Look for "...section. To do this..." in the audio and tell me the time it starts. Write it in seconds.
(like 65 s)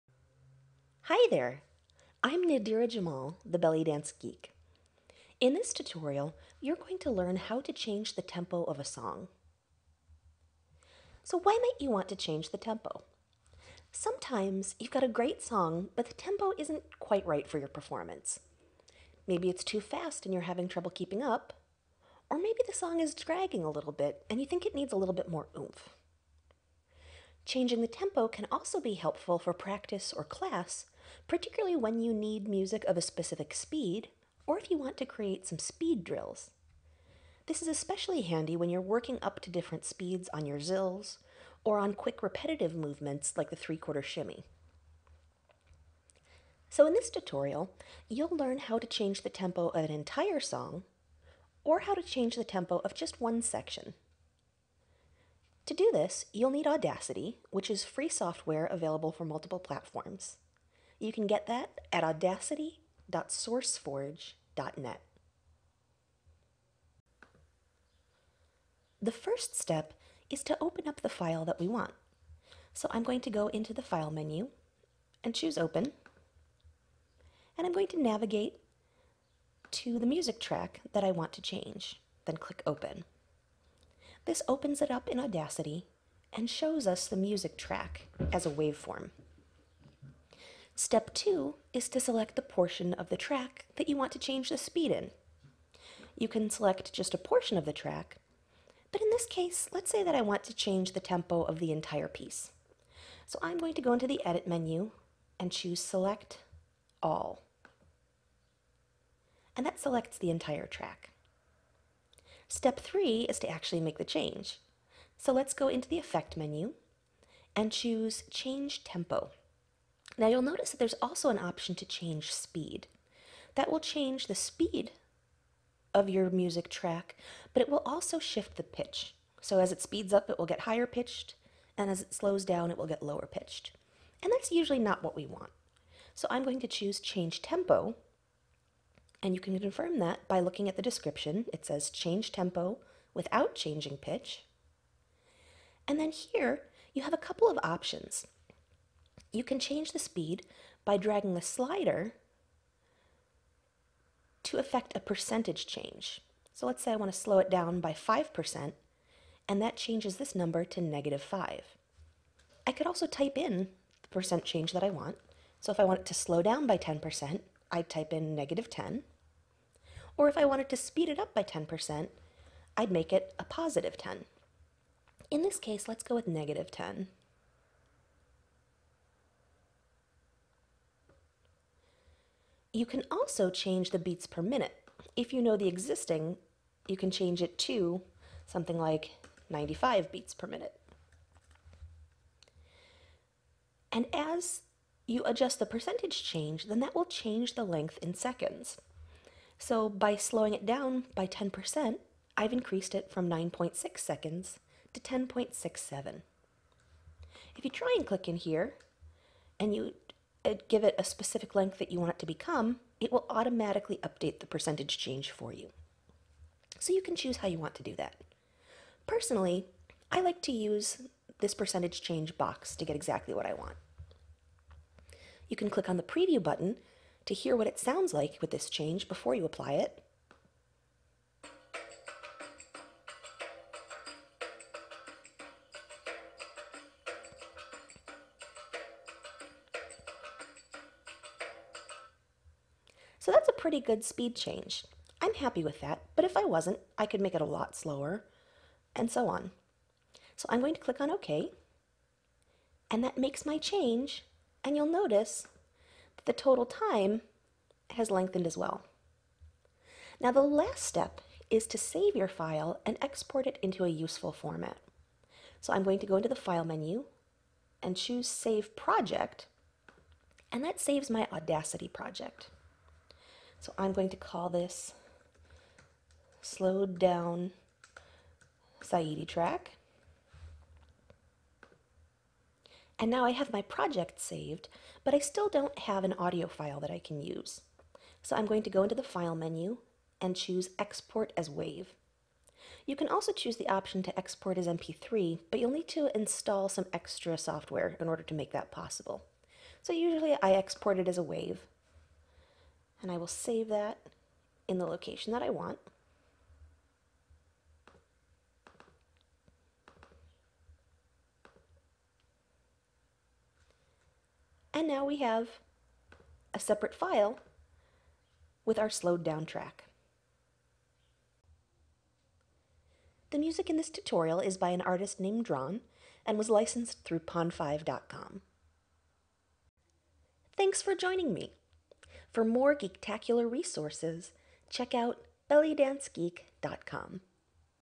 53 s.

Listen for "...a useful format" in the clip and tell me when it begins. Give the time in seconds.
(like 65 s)
263 s.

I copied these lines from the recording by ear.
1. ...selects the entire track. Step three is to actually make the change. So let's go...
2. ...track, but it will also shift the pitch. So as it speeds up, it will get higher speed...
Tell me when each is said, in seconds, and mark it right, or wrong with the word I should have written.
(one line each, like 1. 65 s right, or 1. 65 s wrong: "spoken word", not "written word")
1. 109 s right
2. 126 s wrong: "pitched", not "speed".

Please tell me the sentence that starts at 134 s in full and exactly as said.
And that's usually not what we want.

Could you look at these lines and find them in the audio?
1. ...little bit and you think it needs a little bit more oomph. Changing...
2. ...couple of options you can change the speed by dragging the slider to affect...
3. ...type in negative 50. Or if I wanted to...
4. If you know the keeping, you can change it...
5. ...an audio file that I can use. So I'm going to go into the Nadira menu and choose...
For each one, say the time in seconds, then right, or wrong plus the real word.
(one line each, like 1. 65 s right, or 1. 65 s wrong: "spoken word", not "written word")
1. 23 s right
2. 147 s right
3. 167 s wrong: "10", not "50"
4. 185 s wrong: "existing", not "keeping"
5. 286 s wrong: "File", not "Nadira".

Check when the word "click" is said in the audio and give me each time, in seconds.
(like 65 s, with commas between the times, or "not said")
82 s, 208 s, 225 s, 250 s.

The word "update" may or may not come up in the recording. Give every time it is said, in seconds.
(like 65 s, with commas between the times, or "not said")
214 s.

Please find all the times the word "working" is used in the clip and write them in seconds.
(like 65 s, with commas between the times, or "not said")
38 s.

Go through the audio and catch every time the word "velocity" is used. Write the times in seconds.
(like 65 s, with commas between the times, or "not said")
not said.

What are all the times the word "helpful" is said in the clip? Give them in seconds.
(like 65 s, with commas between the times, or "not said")
28 s.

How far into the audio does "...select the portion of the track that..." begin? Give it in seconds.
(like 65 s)
91 s.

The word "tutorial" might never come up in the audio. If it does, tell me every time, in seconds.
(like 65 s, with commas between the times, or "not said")
5 s, 47 s, 323 s.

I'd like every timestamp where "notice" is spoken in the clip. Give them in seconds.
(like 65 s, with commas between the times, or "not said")
120 s, 254 s.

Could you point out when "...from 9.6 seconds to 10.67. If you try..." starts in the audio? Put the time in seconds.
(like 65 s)
203 s.